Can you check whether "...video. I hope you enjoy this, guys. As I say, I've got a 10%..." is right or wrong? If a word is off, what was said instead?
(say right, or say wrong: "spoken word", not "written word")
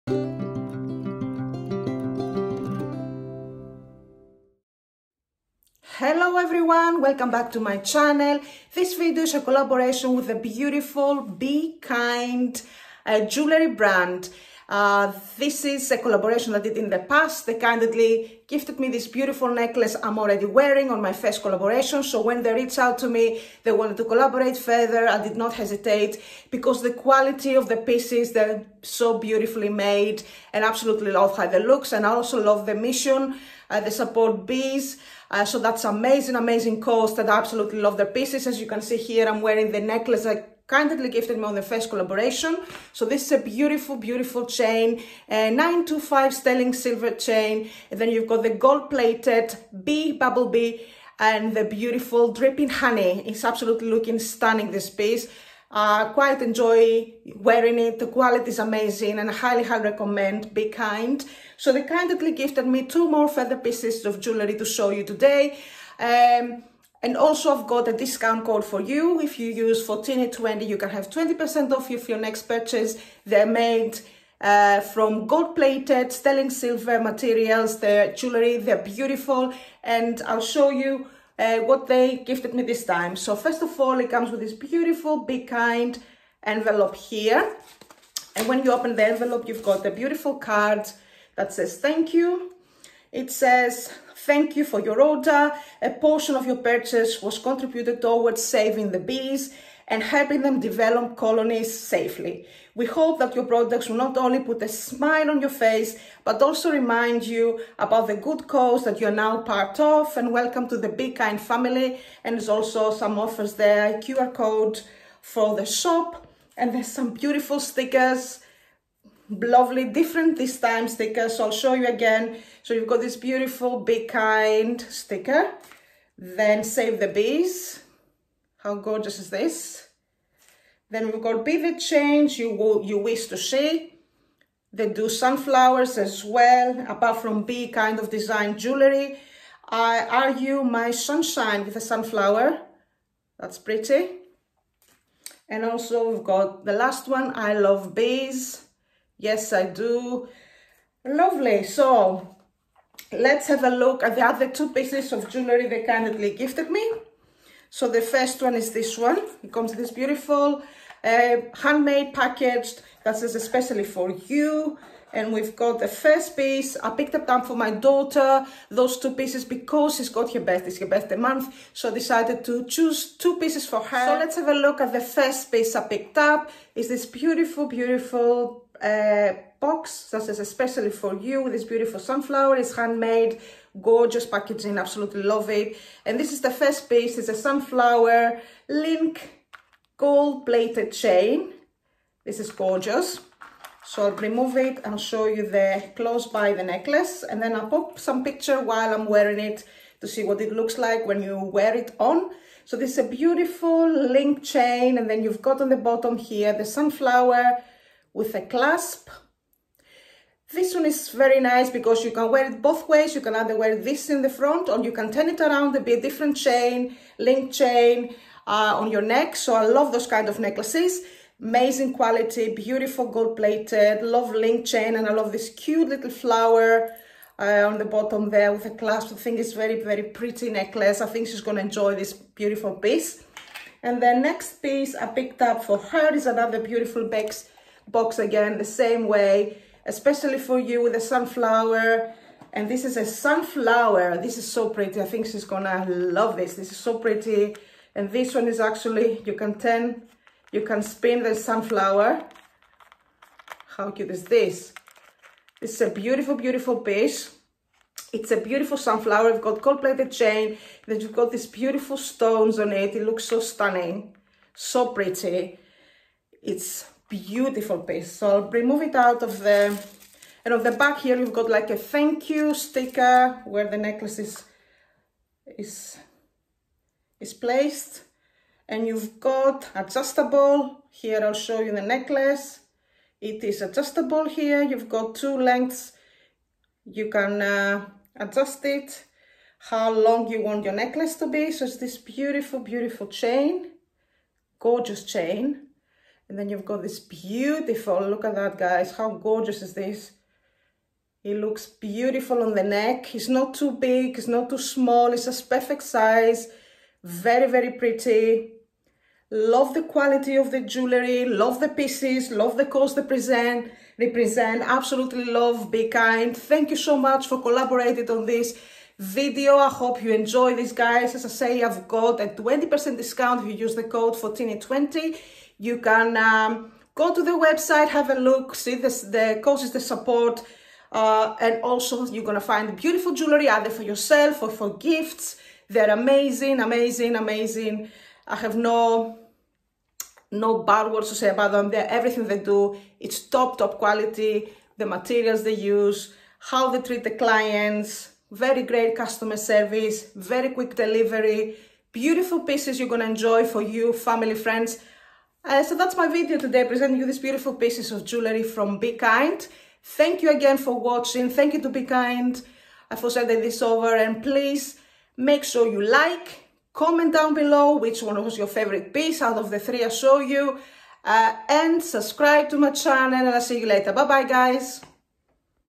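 wrong: "20", not "10".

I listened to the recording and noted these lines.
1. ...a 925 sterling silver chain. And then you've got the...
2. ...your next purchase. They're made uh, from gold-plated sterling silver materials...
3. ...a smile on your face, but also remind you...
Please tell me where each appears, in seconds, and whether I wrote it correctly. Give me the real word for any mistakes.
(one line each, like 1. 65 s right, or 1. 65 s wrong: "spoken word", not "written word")
1. 45 s right
2. 71 s right
3. 104 s right.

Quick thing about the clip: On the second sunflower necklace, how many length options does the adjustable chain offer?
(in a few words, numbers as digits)
2.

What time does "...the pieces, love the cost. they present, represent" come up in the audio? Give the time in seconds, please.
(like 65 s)
311 s.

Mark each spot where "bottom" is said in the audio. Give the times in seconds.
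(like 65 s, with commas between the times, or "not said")
205 s, 227 s.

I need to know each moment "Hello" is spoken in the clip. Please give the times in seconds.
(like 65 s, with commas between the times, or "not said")
6 s.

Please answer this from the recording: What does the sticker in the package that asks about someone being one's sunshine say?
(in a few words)
are you my sunshine.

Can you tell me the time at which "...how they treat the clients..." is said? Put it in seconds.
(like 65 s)
346 s.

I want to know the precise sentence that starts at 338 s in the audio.
I have no no bad words to say about them.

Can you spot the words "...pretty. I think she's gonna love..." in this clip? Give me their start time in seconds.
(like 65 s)
244 s.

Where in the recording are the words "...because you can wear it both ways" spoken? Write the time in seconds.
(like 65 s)
211 s.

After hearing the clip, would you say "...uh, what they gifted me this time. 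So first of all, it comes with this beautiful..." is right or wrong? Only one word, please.
right.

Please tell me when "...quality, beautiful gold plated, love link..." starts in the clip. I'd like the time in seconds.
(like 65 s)
221 s.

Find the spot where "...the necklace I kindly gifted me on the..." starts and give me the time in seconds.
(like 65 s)
39 s.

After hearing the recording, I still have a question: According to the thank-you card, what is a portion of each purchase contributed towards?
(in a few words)
saving the bees.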